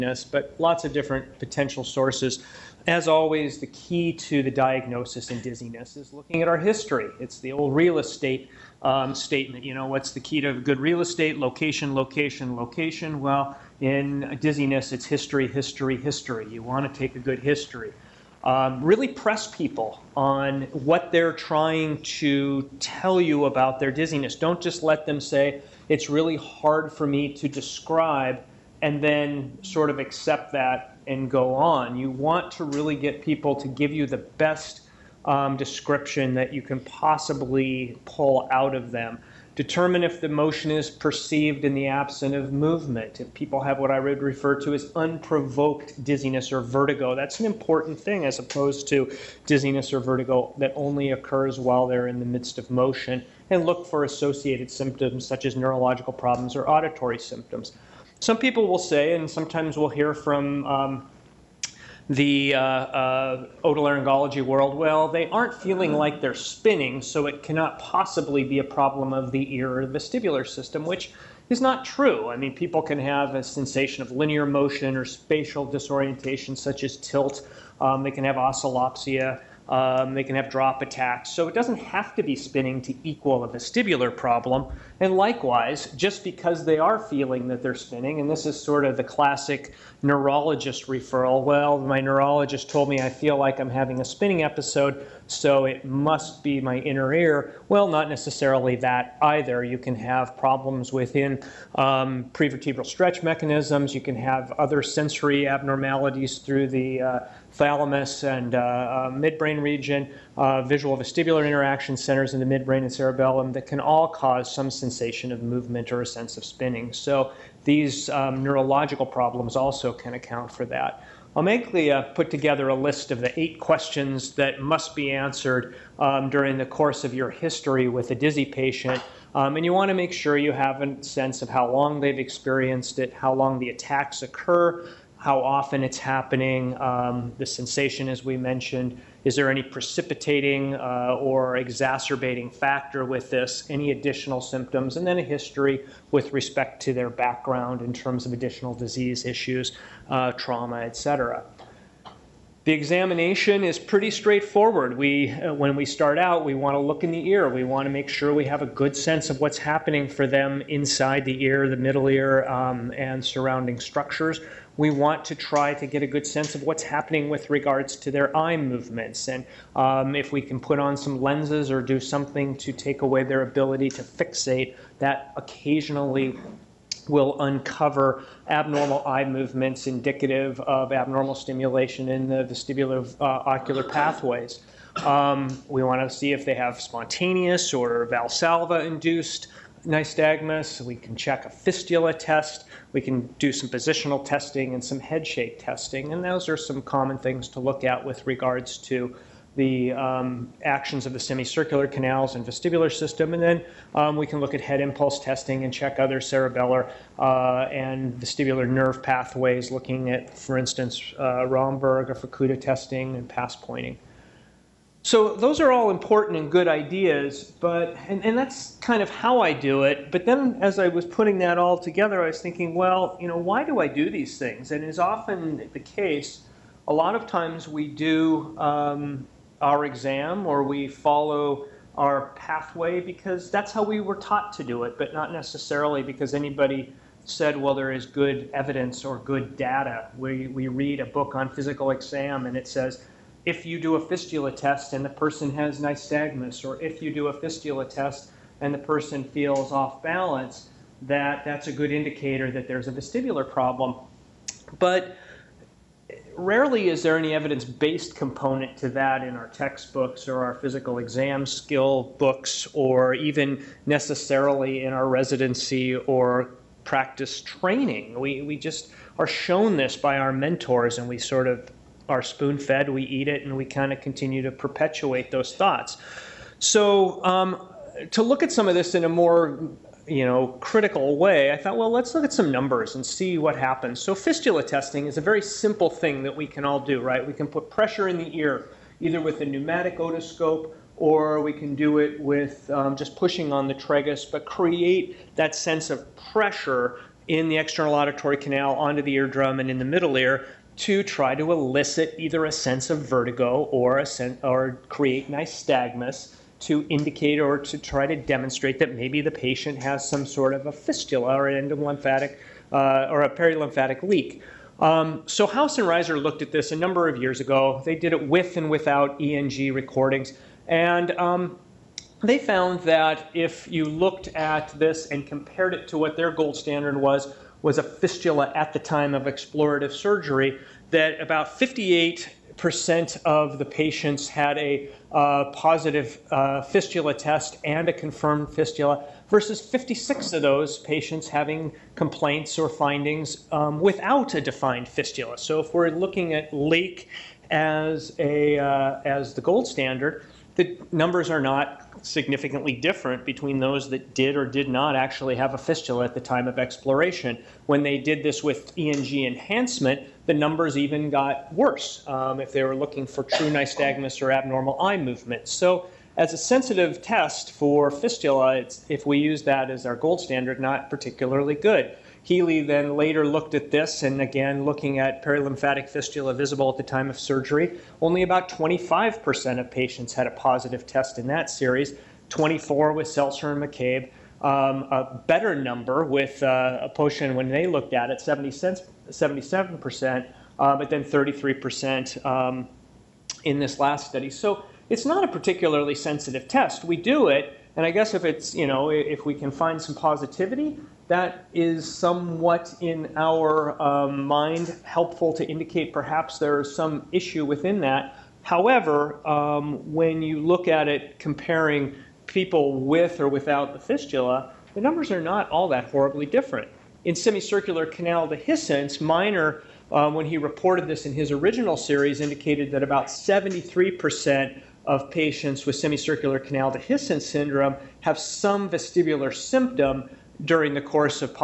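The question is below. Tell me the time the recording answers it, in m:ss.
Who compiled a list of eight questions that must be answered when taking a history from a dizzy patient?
2:01.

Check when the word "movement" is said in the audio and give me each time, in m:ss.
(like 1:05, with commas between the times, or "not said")
0:42, 1:55, 2:48, 2:59, 6:04.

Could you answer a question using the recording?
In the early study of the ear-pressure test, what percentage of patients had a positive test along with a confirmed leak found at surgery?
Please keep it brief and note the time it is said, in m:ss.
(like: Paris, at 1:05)
58%, at 5:31.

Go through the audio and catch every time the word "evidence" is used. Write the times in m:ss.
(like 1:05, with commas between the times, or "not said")
3:58, 4:17.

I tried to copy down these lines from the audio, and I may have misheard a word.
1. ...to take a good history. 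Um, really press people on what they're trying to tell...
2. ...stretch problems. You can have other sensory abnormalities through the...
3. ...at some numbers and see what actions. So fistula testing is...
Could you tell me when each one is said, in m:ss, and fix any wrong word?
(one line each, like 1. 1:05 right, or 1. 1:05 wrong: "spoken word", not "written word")
1. 0:16 right
2. 1:42 wrong: "mechanisms", not "problems"
3. 4:42 wrong: "happens", not "actions".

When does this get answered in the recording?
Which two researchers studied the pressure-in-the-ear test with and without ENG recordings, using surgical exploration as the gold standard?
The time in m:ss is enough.
5:15.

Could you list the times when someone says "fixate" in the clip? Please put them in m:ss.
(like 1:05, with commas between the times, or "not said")
2:54.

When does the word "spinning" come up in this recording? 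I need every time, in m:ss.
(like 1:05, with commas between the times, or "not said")
1:06, 1:22, 1:27, 1:34, 1:56.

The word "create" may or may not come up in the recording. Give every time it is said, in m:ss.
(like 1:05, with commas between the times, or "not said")
4:54, 5:04.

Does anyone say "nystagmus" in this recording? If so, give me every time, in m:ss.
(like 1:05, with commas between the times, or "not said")
3:09, 4:05, 5:05, 6:03.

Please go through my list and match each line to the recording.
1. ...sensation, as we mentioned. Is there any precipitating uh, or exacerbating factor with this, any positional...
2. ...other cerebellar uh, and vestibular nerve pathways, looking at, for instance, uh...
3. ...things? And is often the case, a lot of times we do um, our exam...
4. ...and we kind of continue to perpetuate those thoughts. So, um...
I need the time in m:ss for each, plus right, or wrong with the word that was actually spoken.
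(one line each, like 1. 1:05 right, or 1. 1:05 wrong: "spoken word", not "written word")
1. 2:17 wrong: "additional", not "positional"
2. 3:25 right
3. 3:44 right
4. 4:33 right.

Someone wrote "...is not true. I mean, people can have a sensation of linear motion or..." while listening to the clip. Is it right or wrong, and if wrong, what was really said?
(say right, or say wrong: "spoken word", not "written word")
right.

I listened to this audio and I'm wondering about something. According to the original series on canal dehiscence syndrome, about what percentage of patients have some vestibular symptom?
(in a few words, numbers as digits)
73%.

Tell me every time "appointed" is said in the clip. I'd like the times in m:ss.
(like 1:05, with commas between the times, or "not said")
not said.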